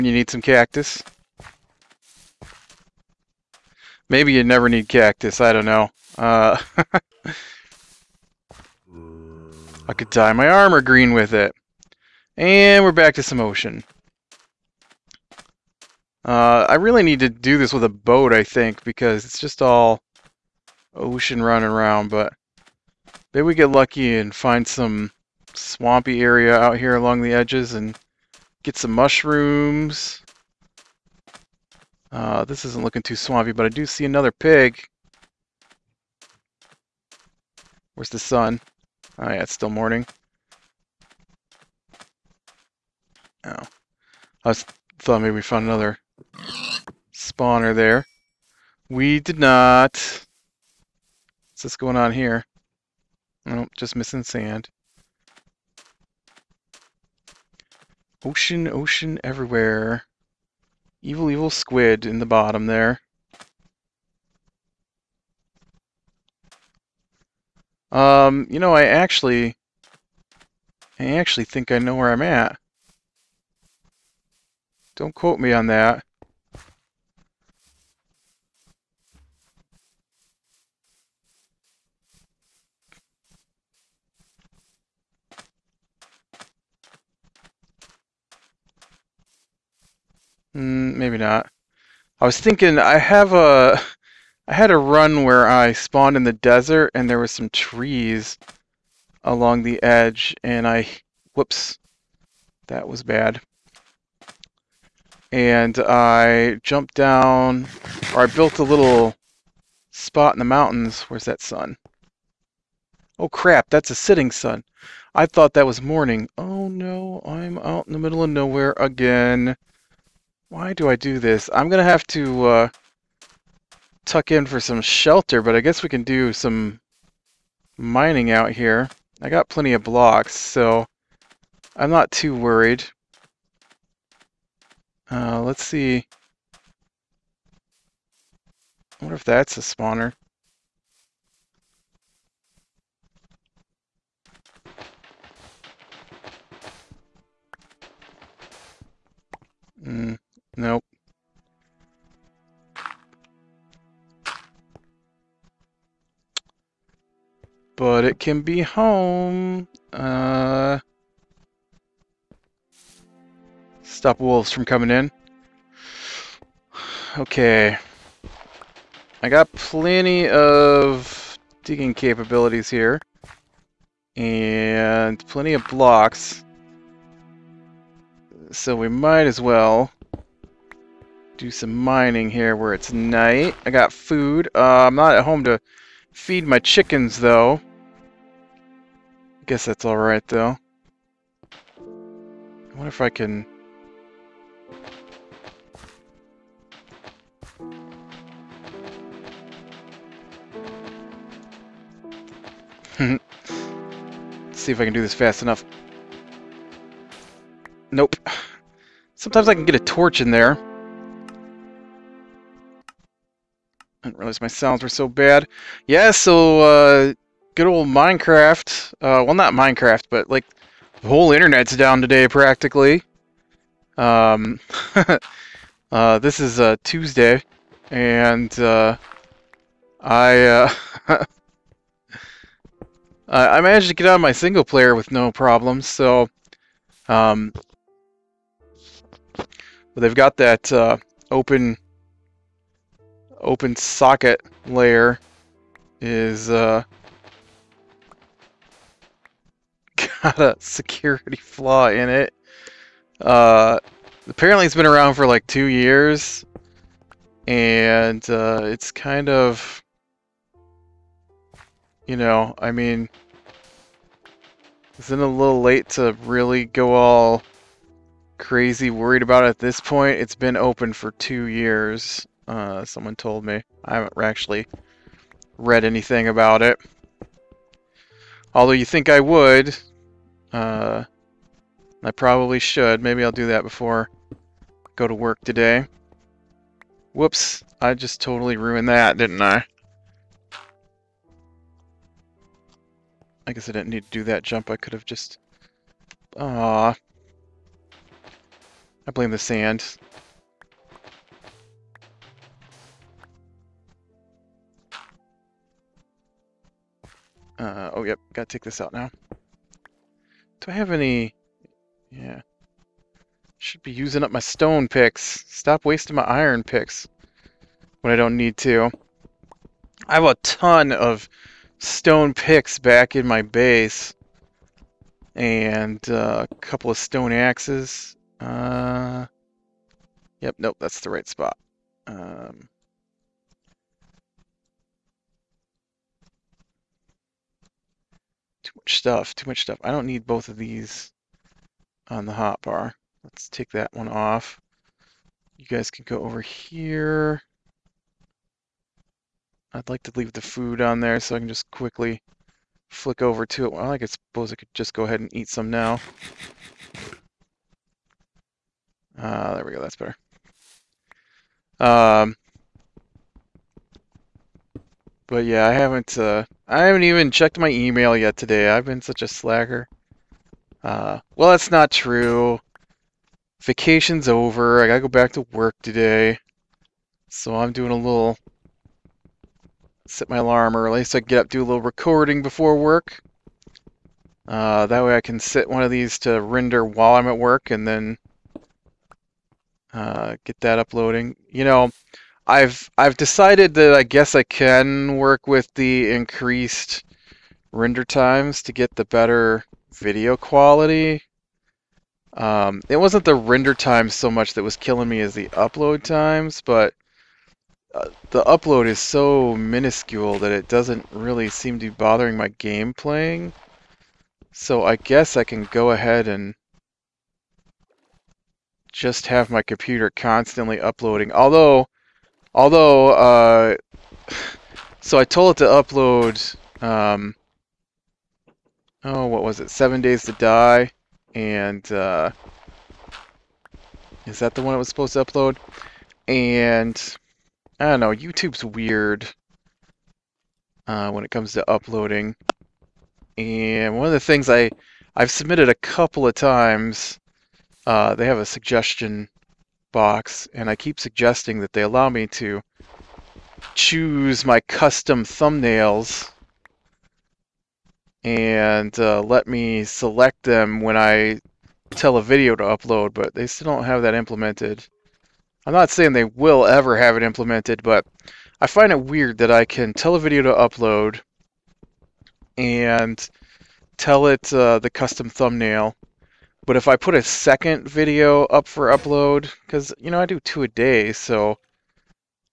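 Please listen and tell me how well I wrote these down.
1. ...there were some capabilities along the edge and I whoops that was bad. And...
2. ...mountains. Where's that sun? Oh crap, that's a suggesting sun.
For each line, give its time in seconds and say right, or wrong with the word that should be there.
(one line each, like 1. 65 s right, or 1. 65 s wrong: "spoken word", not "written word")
1. 97 s wrong: "trees", not "capabilities"
2. 110 s wrong: "sitting", not "suggesting".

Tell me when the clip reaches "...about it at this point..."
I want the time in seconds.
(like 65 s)
269 s.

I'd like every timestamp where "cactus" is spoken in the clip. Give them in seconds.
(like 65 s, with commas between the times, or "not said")
0 s, 4 s.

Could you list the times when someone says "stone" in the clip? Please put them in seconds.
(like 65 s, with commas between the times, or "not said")
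314 s, 321 s, 326 s.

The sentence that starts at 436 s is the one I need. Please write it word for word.
And, I don't know, YouTube's weird uh, when it comes to uploading.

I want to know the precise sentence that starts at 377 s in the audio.
So I'm doing a little set my alarm early so I can get up do a little recording before work.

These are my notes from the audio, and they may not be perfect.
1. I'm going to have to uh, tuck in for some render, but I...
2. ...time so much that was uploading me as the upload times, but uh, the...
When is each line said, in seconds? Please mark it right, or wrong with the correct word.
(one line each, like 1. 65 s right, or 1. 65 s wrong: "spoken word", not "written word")
1. 121 s wrong: "shelter", not "render"
2. 403 s wrong: "killing", not "uploading".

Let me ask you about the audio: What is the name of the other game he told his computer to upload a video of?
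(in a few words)
Seven Days to Die.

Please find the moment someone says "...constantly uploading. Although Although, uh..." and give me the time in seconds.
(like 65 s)
420 s.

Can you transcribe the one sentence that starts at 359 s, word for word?
Uh, there we go, that's better.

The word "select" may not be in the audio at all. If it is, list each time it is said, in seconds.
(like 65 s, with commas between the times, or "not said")
459 s.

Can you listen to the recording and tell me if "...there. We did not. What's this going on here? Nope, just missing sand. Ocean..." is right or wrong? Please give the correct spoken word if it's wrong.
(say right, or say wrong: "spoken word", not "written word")
right.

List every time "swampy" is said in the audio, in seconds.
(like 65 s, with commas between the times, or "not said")
25 s, 33 s.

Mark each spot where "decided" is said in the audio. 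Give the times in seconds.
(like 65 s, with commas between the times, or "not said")
393 s.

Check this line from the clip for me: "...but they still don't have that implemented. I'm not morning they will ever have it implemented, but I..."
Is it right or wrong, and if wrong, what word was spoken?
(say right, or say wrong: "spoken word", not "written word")
wrong: "saying", not "morning".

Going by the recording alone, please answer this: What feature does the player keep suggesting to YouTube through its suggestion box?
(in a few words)
Custom thumbnails.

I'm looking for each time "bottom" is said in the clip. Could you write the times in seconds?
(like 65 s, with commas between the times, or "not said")
62 s.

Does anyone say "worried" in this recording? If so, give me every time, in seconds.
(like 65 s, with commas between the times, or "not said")
132 s, 268 s.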